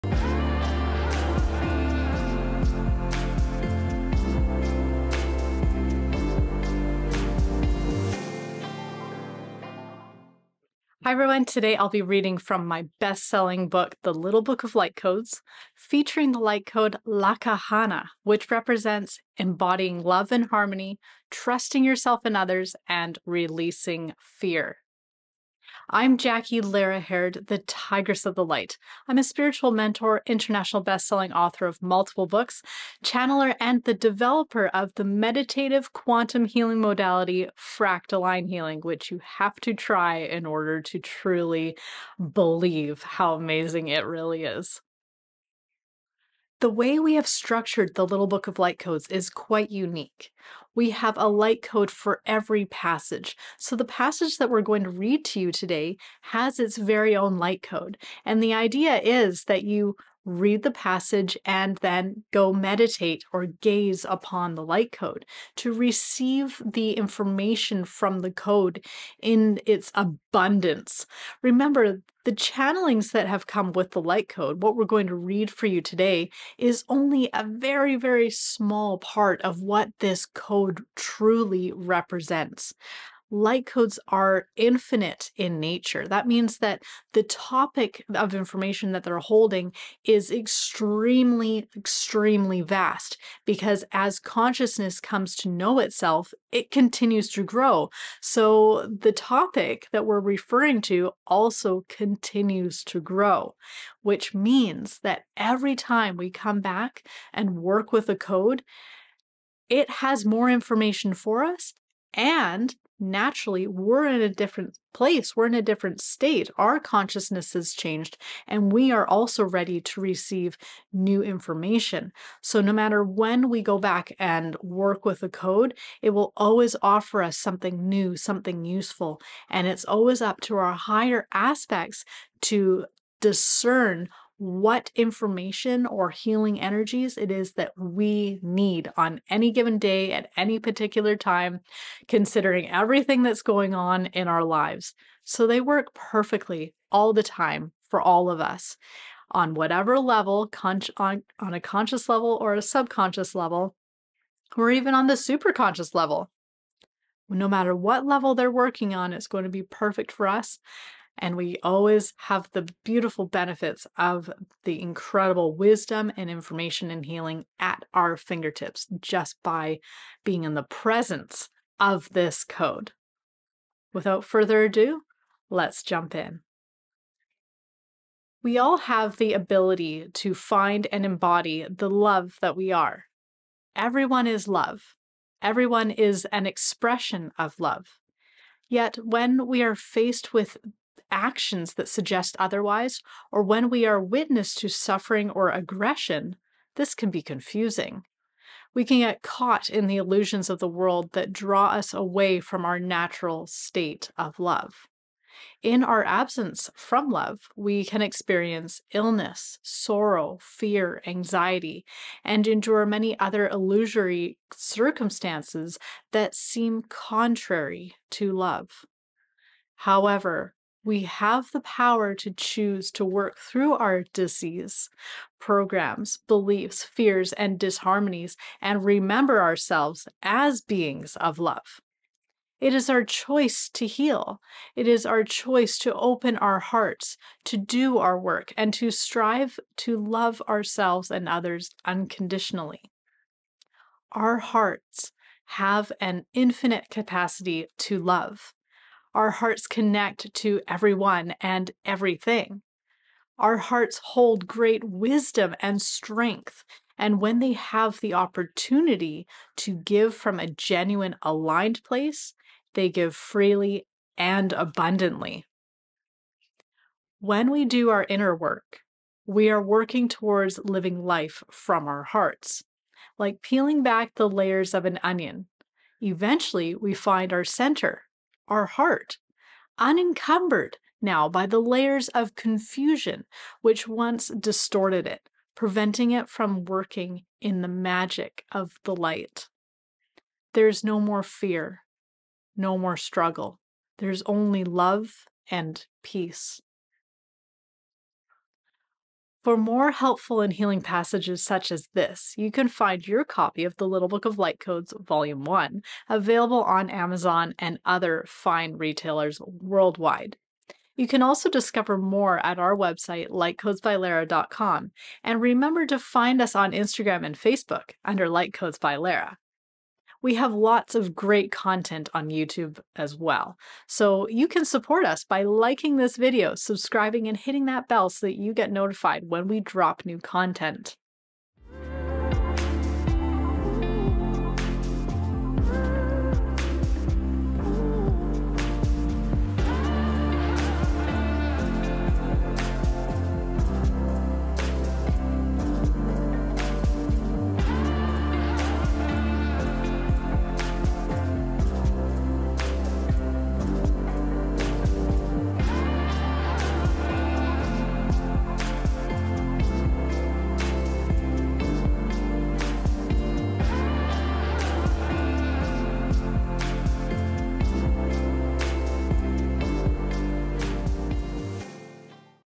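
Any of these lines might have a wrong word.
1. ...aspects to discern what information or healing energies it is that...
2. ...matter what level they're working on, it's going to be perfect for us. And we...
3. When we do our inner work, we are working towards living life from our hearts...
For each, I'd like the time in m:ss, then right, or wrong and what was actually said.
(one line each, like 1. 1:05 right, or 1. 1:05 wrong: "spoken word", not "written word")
1. 2:11 right
2. 2:37 right
3. 4:27 right.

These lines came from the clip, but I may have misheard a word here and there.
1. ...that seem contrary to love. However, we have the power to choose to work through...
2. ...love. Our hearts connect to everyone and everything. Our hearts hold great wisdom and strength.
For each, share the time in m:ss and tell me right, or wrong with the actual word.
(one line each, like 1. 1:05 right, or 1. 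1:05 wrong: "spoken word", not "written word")
1. 3:36 right
2. 4:07 right.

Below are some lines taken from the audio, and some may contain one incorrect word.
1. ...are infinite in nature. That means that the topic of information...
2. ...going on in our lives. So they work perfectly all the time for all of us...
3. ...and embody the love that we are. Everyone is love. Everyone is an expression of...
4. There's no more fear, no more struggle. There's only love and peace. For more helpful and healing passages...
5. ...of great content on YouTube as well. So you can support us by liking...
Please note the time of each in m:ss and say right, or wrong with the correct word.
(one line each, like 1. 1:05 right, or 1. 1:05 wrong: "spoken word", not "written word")
1. 1:24 right
2. 2:23 right
3. 3:00 right
4. 4:50 right
5. 5:20 right.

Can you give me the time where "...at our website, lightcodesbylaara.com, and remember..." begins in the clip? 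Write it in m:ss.
5:12.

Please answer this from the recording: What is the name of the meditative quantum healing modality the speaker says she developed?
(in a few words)
fractaline healing.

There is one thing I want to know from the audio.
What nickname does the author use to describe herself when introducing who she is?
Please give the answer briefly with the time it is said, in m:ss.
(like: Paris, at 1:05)
the Tigress of the Light, at 0:27.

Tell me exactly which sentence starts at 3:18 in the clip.
We can get caught in the illusions of the world that draw us away from our natural state of love.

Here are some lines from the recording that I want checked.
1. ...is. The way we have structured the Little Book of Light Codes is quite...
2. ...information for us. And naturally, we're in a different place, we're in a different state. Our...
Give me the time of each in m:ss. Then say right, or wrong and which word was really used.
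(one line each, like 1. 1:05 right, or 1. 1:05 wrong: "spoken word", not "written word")
1. 0:44 right
2. 1:50 right.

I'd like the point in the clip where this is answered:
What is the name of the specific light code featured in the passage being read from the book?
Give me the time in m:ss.
0:17.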